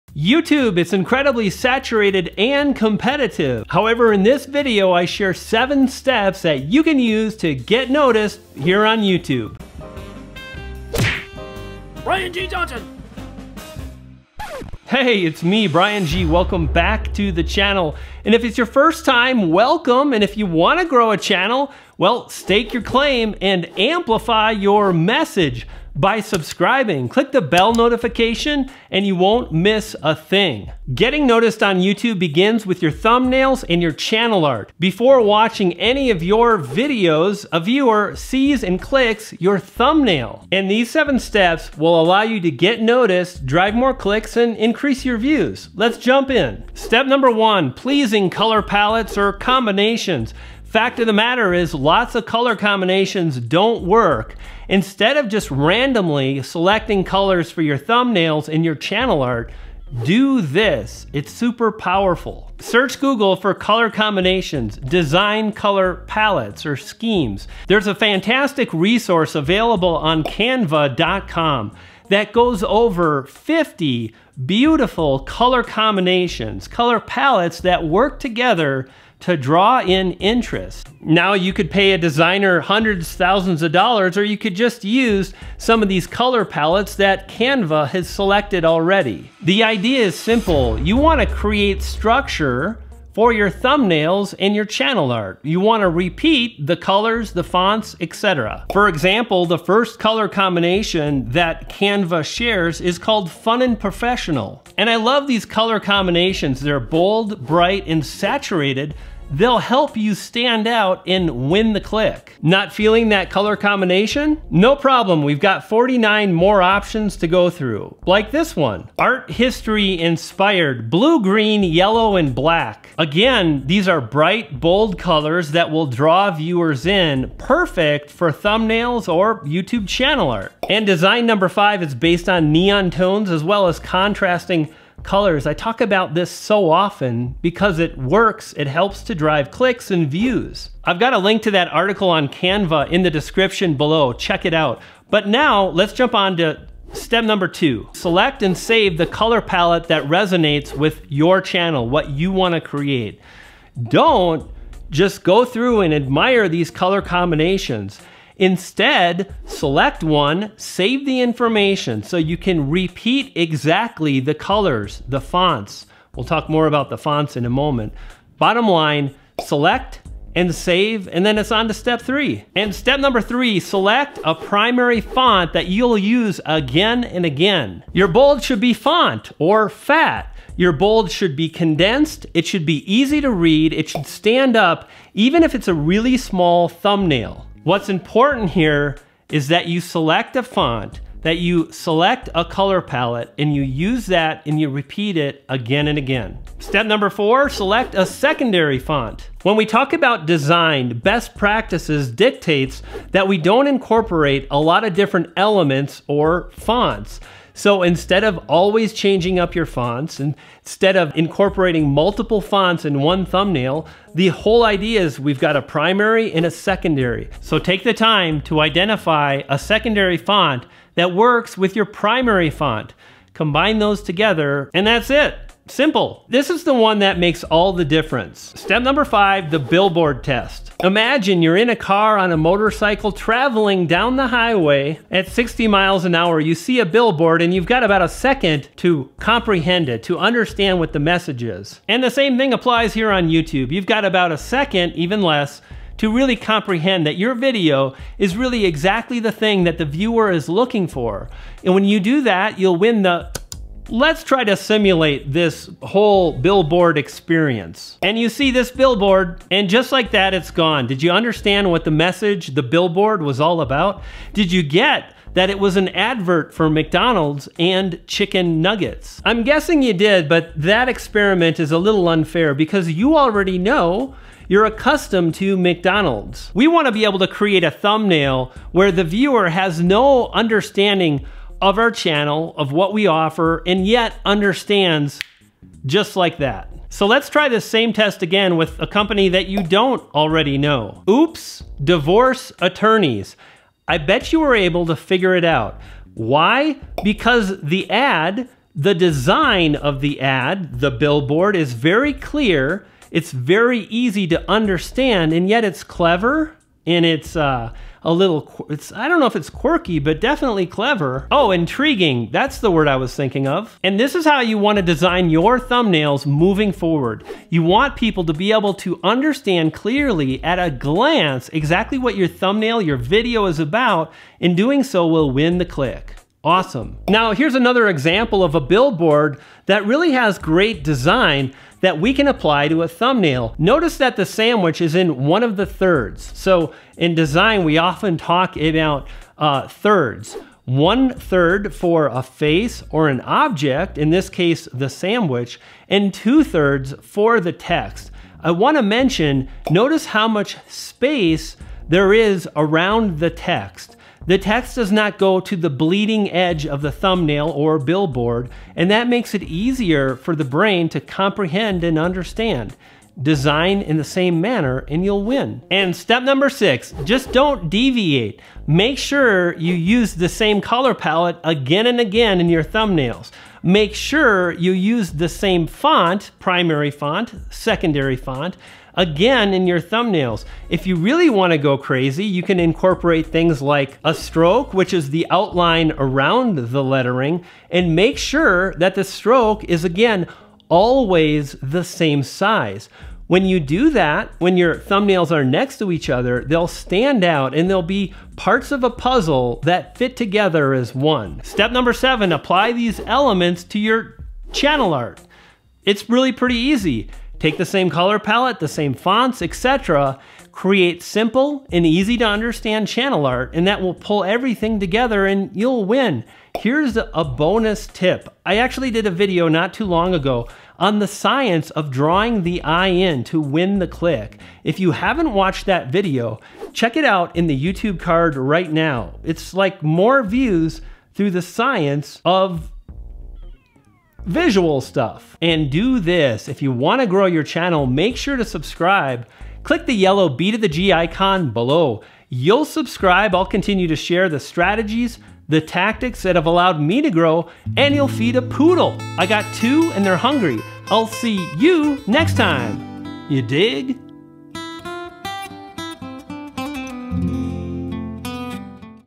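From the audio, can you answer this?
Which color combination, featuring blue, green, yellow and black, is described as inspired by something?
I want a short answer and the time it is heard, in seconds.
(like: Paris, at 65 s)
Art history, at 118 s.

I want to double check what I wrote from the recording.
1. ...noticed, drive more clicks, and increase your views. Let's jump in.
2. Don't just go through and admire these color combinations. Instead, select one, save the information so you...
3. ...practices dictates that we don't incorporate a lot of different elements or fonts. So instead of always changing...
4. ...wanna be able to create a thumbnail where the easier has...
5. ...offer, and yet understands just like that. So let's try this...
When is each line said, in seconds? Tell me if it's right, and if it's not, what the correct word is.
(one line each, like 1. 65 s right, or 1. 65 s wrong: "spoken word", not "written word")
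1. 42 s right
2. 153 s right
3. 201 s right
4. 276 s wrong: "viewer", not "easier"
5. 283 s right.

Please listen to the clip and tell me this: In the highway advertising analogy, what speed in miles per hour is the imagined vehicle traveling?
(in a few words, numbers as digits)
60.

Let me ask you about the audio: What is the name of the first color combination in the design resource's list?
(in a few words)
Fun and Professional.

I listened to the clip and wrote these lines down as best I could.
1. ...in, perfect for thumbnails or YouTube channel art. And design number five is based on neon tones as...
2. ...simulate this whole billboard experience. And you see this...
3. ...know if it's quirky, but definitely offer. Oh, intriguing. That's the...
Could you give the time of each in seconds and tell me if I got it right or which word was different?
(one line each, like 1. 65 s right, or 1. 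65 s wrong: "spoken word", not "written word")
1. 126 s right
2. 254 s right
3. 309 s wrong: "clever", not "offer".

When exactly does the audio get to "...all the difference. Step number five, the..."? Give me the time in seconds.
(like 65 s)
227 s.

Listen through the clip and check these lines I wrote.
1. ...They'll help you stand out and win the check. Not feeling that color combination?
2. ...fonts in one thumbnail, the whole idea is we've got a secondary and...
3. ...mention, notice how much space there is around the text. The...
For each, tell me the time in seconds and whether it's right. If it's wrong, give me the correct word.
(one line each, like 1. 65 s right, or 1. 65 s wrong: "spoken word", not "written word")
1. 109 s wrong: "click", not "check"
2. 212 s wrong: "primary", not "secondary"
3. 348 s right.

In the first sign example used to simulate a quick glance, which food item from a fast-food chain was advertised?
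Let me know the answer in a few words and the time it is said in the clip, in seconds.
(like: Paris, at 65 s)
Chicken nuggets, at 268 s.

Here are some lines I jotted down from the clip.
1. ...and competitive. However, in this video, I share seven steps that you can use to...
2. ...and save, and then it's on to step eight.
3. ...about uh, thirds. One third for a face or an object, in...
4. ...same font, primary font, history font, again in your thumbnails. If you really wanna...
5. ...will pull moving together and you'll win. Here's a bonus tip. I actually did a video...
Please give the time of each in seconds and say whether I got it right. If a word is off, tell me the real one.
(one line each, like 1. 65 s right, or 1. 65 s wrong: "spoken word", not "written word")
1. 2 s right
2. 170 s wrong: "three", not "eight"
3. 338 s right
4. 375 s wrong: "secondary", not "history"
5. 413 s wrong: "everything", not "moving".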